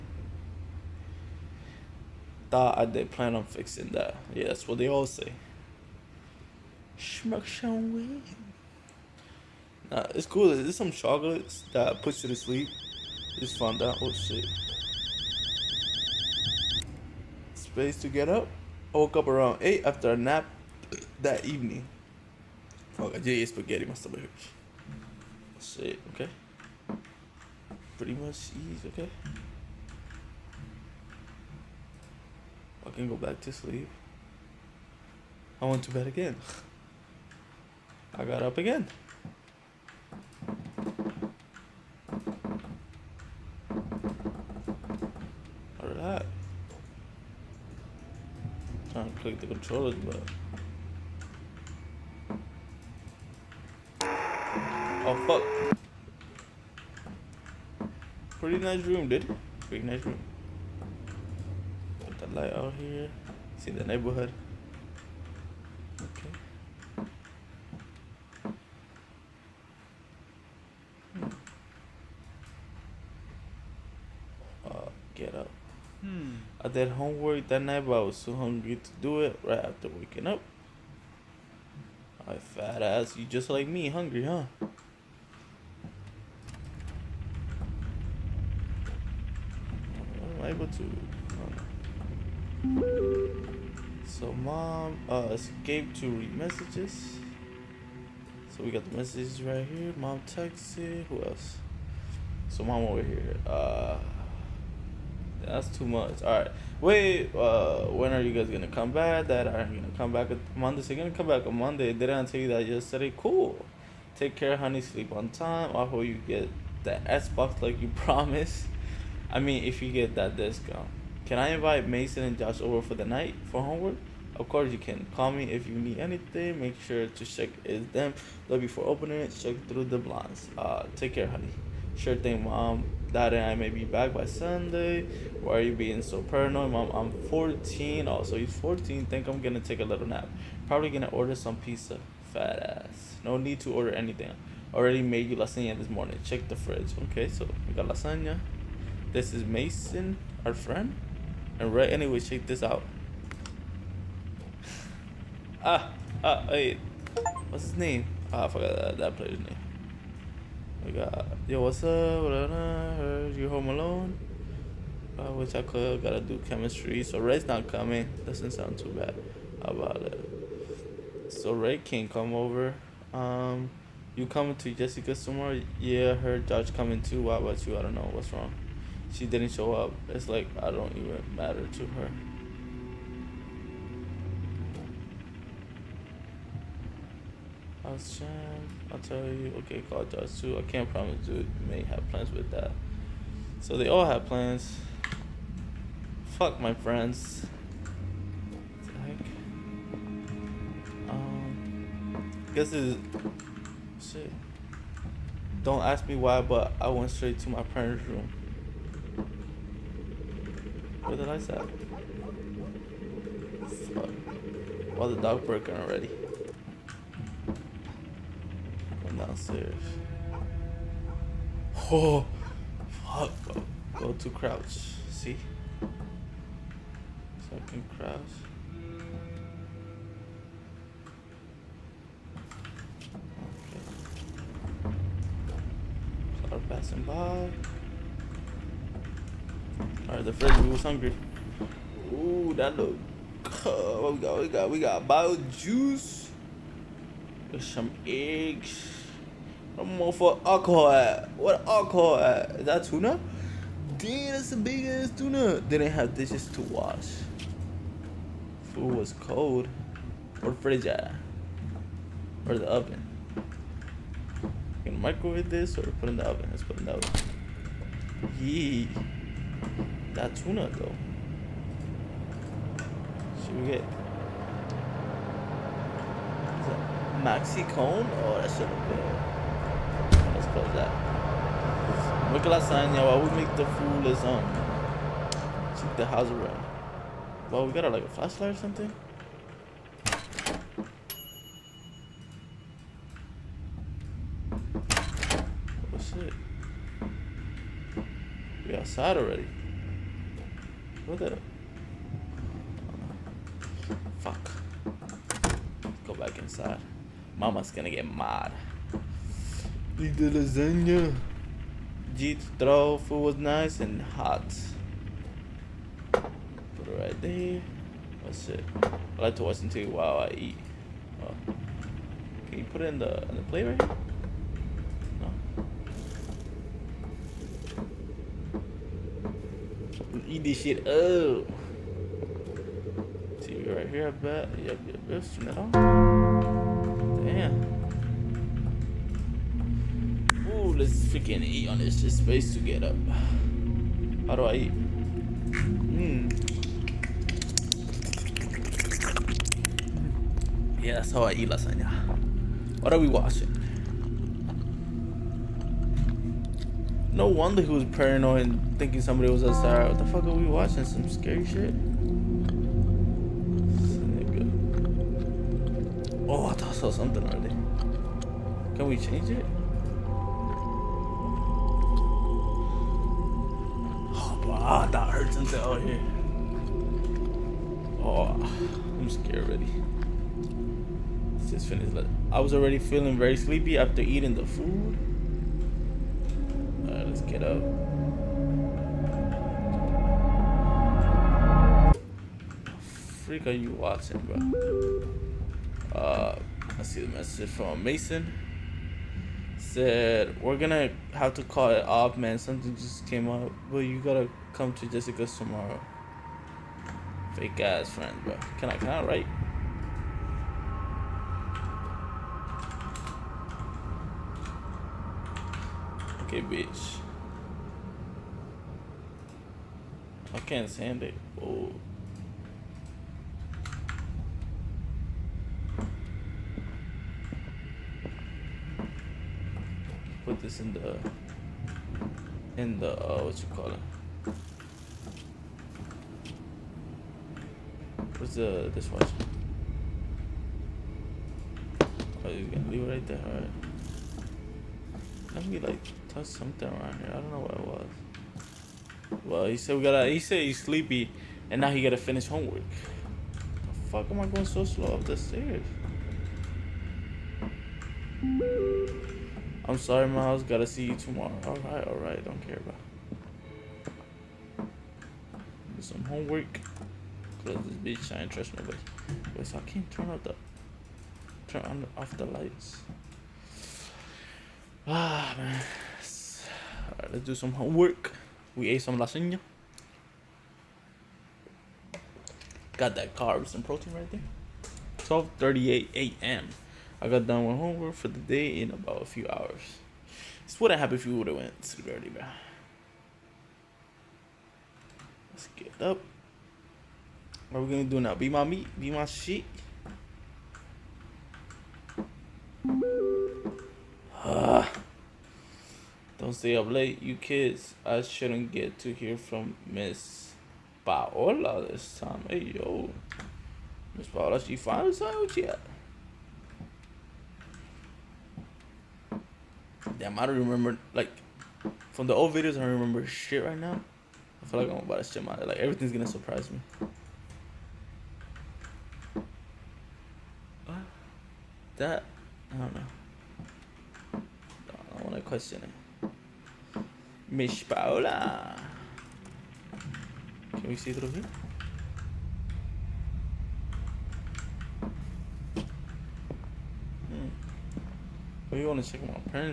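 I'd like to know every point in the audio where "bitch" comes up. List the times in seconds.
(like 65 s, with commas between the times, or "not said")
416 s, 467 s.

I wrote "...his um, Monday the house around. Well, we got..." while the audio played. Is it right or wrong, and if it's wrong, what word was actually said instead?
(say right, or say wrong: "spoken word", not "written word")
wrong: "Check", not "Monday".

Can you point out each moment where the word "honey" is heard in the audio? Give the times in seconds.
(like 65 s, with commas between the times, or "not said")
114 s, 131 s.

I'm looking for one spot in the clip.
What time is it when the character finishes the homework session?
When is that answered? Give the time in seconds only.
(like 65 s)
484 s.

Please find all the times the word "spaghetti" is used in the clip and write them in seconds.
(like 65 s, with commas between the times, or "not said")
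23 s.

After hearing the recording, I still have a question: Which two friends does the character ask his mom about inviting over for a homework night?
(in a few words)
Mason and Josh.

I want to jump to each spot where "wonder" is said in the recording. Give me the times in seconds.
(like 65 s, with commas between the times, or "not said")
357 s.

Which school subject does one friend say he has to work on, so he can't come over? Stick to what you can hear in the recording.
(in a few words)
Chemistry.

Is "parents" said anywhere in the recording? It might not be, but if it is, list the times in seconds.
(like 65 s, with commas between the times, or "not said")
207 s.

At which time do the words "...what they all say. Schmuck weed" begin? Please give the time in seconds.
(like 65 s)
4 s.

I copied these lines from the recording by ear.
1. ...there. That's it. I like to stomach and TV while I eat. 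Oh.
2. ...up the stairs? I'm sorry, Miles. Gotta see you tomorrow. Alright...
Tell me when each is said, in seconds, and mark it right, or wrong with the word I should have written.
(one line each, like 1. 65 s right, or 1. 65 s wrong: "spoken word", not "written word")
1. 317 s wrong: "watch", not "stomach"
2. 454 s right.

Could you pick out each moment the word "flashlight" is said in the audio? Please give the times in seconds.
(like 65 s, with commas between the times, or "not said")
288 s.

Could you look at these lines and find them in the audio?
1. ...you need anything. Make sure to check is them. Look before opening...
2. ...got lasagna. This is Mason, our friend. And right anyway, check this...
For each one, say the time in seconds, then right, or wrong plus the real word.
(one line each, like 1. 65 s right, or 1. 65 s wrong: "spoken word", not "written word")
1. 125 s right
2. 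147 s right.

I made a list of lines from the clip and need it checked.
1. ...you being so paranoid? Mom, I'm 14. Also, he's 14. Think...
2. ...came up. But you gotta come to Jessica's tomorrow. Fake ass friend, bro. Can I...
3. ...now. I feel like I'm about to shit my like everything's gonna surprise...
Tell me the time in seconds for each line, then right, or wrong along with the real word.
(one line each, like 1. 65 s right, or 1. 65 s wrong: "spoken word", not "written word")
1. 135 s right
2. 403 s right
3. 523 s right.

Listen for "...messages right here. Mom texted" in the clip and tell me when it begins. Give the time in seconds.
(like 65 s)
98 s.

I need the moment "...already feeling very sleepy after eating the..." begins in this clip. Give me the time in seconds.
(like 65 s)
382 s.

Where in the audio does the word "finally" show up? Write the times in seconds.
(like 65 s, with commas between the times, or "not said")
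514 s.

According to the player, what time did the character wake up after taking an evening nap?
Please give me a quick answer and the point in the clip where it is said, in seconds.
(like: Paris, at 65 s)
8, at 19 s.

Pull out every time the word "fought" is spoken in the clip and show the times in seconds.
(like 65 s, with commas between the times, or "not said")
not said.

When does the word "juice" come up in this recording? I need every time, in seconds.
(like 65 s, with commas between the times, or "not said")
245 s.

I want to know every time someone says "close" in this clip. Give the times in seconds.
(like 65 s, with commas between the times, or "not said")
280 s, 467 s.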